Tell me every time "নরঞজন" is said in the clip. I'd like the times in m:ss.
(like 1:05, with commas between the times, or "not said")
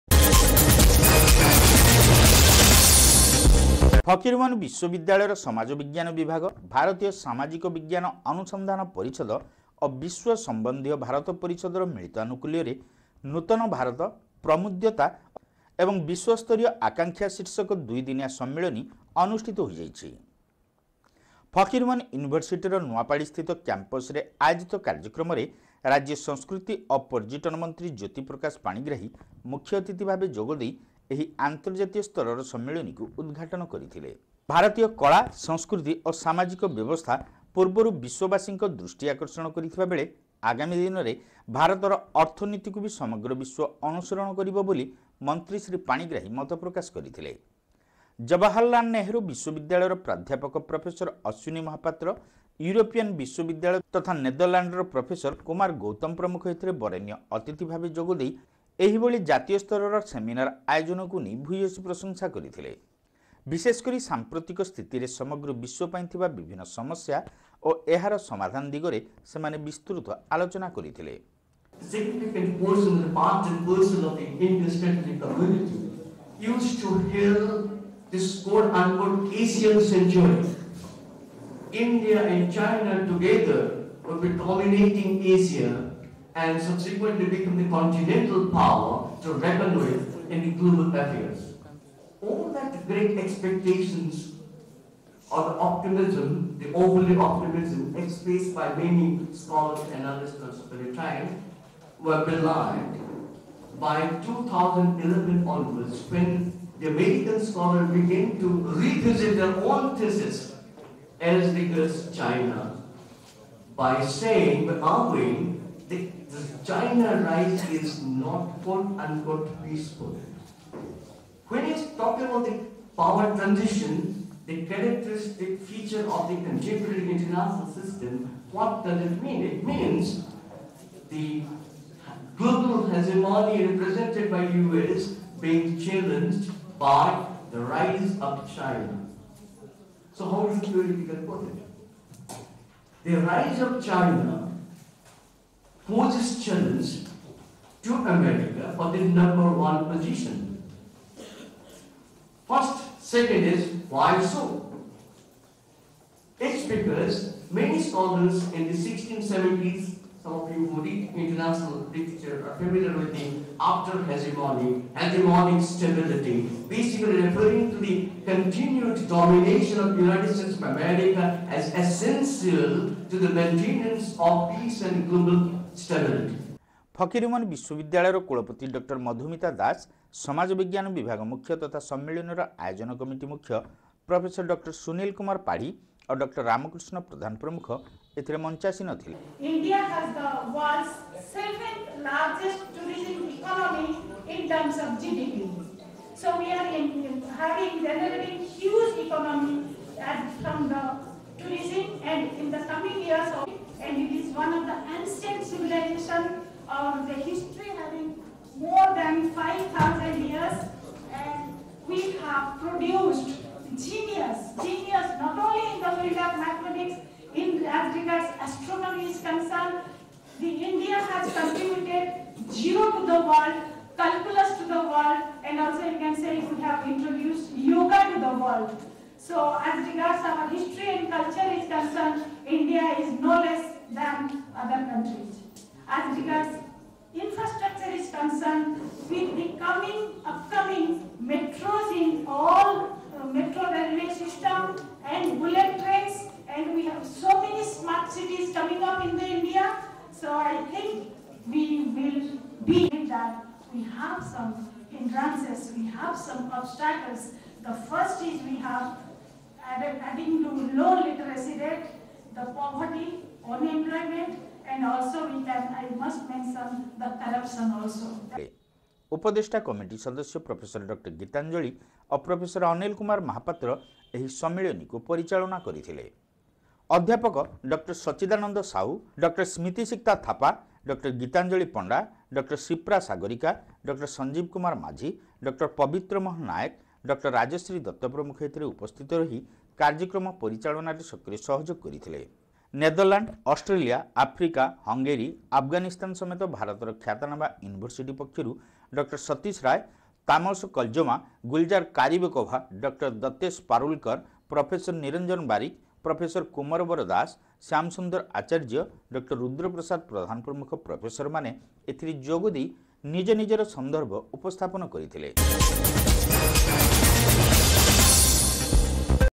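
5:05.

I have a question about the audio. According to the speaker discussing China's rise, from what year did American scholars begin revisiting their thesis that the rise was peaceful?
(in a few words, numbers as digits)
2011.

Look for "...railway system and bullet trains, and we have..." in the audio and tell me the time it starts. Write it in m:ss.
4:03.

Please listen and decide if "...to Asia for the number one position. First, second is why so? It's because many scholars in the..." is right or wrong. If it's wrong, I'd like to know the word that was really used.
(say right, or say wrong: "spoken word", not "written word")
wrong: "America", not "Asia".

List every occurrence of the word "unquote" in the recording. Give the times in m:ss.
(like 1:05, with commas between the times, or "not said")
1:18, 1:58.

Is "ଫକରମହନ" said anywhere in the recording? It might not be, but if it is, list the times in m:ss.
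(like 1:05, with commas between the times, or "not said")
0:04, 0:21.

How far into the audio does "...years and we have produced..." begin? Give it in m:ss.
3:30.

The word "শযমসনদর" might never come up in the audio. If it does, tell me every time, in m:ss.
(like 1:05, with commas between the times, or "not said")
5:07.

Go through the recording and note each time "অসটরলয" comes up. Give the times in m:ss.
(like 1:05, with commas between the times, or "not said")
4:53.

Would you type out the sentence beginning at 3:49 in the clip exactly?
So as regards our history and culture is concerned, India is no less than other countries.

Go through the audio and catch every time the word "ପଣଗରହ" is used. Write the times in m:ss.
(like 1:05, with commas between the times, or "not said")
0:28, 0:45.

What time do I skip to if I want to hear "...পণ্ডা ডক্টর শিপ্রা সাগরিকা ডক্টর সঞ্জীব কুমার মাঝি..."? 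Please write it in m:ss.
4:41.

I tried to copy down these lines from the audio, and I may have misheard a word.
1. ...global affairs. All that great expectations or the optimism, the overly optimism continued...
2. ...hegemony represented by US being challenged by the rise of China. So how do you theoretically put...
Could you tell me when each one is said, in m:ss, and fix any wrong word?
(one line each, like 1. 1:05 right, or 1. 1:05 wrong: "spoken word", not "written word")
1. 1:30 wrong: "expressed", not "continued"
2. 2:12 right.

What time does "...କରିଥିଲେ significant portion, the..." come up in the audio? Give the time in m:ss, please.
1:10.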